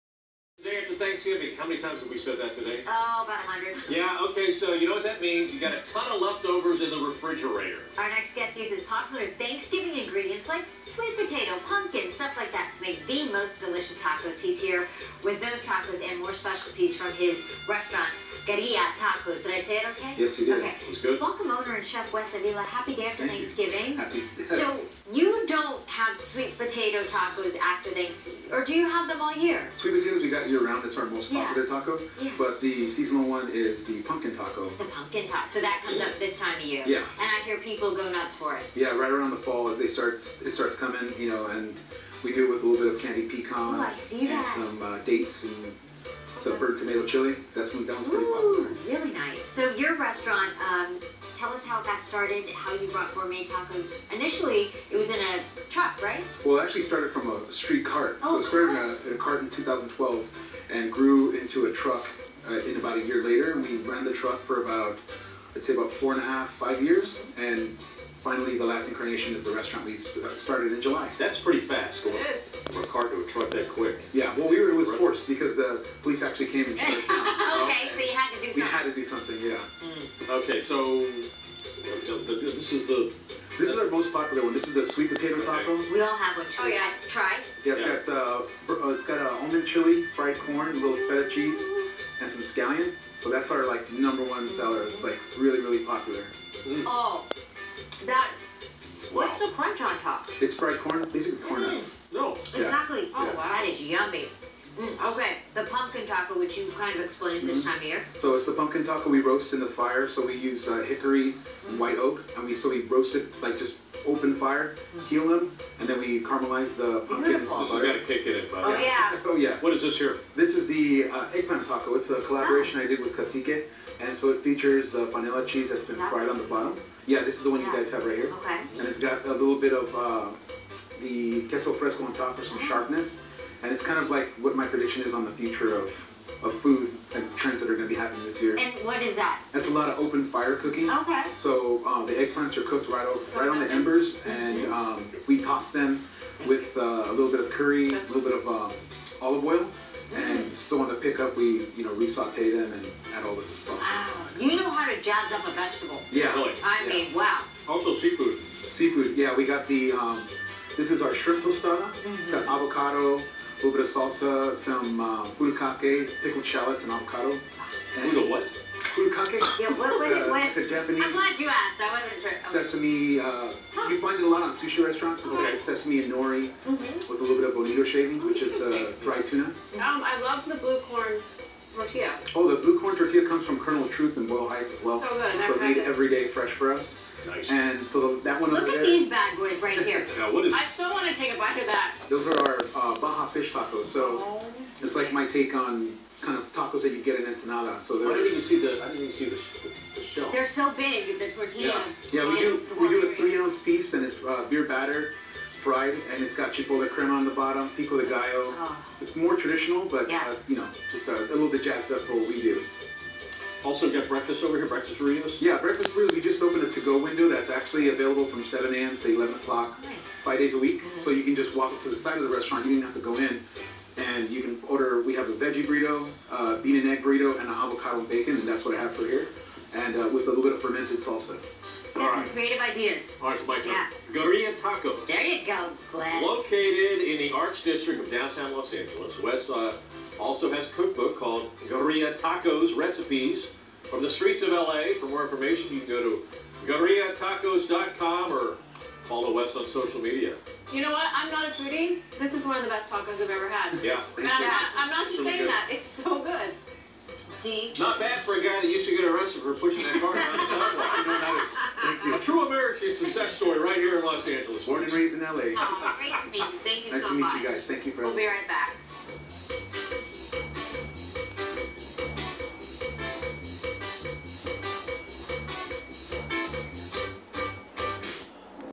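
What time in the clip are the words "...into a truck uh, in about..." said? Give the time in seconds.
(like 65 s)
61 s.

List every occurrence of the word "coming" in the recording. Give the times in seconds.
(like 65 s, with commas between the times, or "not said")
40 s.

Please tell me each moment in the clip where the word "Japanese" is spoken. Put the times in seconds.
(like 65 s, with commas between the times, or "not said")
170 s.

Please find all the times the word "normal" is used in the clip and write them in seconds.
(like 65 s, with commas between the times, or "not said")
not said.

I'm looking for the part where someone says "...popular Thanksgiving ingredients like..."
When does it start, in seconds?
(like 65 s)
8 s.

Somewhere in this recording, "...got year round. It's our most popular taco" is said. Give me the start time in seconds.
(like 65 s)
30 s.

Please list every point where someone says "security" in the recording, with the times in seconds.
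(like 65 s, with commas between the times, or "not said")
not said.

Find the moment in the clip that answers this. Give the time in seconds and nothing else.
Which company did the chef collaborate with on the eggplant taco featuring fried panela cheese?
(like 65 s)
123 s.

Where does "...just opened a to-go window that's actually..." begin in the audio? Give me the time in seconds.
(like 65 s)
216 s.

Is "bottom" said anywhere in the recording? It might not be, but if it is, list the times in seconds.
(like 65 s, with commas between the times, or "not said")
126 s, 207 s.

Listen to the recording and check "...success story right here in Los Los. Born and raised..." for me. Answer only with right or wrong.
wrong.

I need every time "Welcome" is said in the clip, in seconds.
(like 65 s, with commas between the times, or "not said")
21 s.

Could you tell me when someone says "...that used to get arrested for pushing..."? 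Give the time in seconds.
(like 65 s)
258 s.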